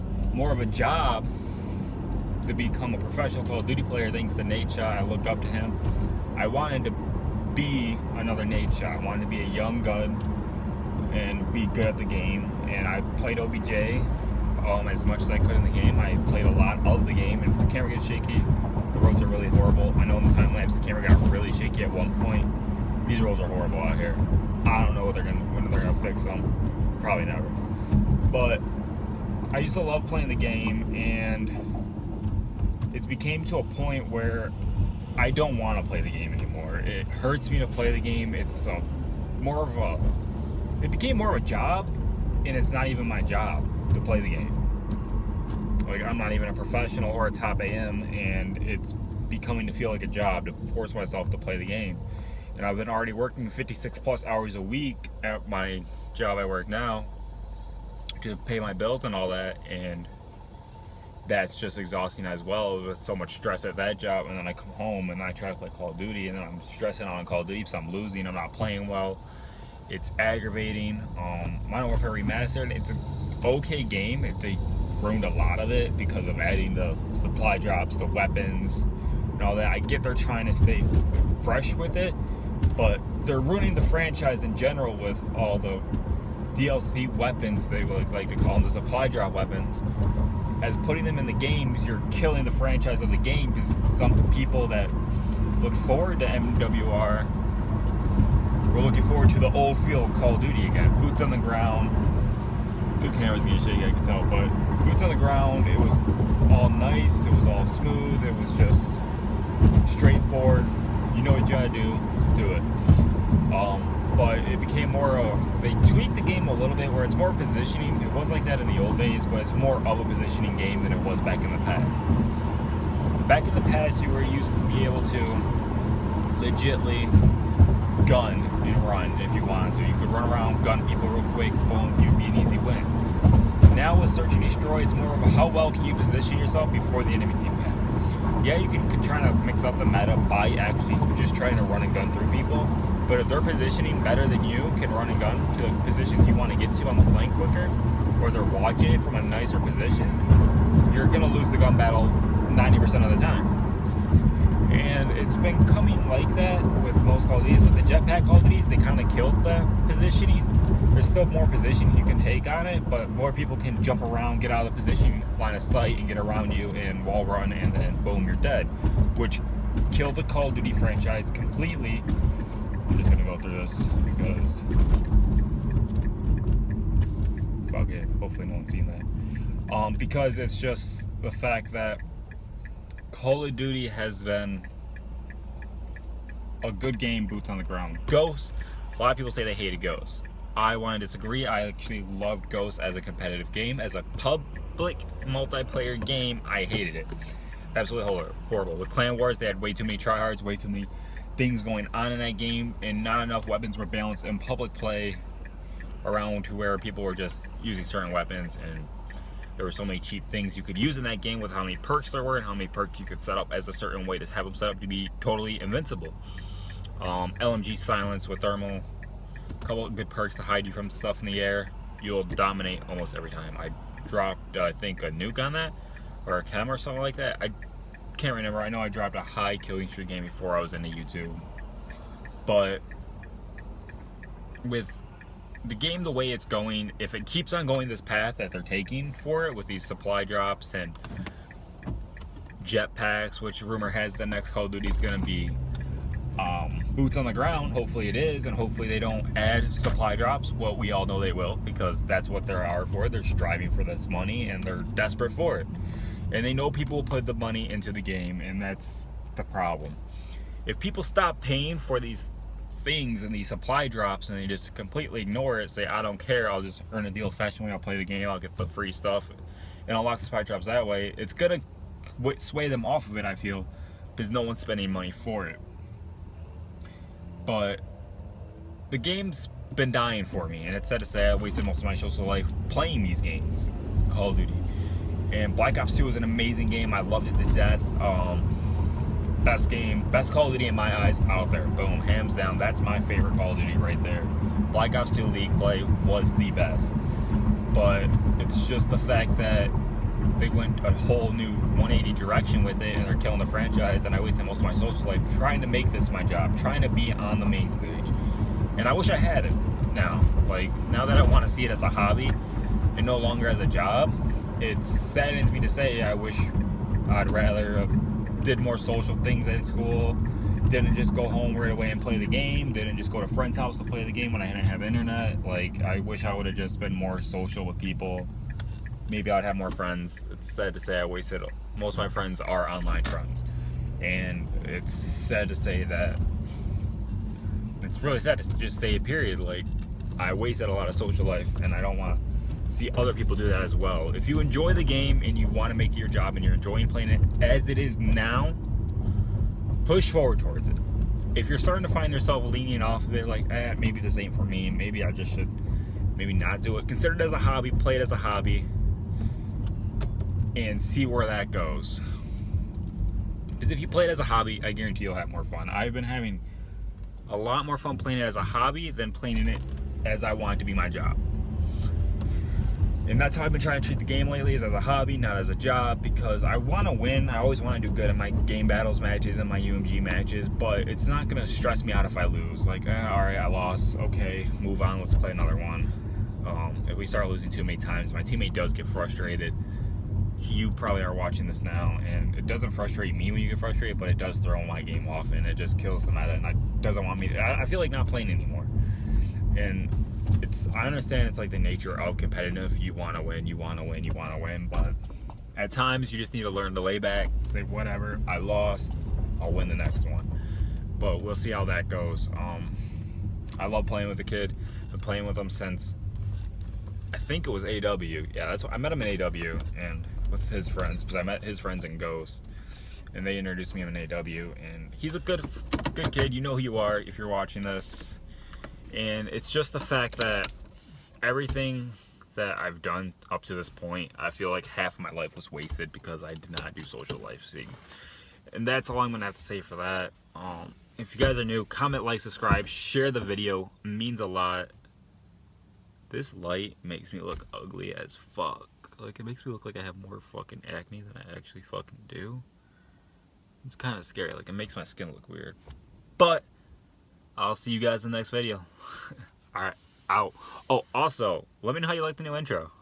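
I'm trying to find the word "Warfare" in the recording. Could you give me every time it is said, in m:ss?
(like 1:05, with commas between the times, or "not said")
1:11.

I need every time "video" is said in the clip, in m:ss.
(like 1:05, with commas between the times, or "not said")
7:23, 7:38.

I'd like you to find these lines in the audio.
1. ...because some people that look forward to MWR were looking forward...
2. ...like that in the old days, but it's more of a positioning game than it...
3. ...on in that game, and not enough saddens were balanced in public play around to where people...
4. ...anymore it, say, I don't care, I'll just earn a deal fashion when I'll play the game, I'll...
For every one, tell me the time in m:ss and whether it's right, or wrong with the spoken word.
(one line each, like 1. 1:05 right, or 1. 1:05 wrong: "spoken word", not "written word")
1. 1:33 right
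2. 1:58 right
3. 3:21 wrong: "weapons", not "saddens"
4. 4:25 wrong: "ignore", not "anymore".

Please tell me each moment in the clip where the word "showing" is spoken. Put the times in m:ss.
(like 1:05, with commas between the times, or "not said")
not said.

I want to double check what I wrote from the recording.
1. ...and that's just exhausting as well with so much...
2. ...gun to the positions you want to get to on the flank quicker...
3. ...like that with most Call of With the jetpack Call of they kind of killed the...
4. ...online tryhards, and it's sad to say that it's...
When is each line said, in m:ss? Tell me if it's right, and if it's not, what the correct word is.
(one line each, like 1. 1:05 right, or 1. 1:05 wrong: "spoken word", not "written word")
1. 0:59 right
2. 2:25 right
3. 2:36 right
4. 5:32 wrong: "friends", not "tryhards".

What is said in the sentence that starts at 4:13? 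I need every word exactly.
They're striving for this money and they're desperate for it.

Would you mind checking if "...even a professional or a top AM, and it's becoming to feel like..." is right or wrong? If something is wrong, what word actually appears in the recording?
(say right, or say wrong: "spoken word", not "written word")
right.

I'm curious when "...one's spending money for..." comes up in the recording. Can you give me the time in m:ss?
4:34.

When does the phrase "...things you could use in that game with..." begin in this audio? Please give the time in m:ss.
3:30.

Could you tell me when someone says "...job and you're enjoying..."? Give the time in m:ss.
5:46.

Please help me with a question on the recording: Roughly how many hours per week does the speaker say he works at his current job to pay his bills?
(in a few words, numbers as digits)
56.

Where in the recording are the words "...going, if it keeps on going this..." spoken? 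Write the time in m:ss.
3:56.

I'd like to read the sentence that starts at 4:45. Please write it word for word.
And Black Ops 2 was an amazing game.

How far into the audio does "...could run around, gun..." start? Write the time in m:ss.
2:09.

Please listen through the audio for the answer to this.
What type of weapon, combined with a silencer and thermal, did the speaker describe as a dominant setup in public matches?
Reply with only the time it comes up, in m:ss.
3:37.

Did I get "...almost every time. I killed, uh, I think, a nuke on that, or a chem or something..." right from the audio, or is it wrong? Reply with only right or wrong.
wrong.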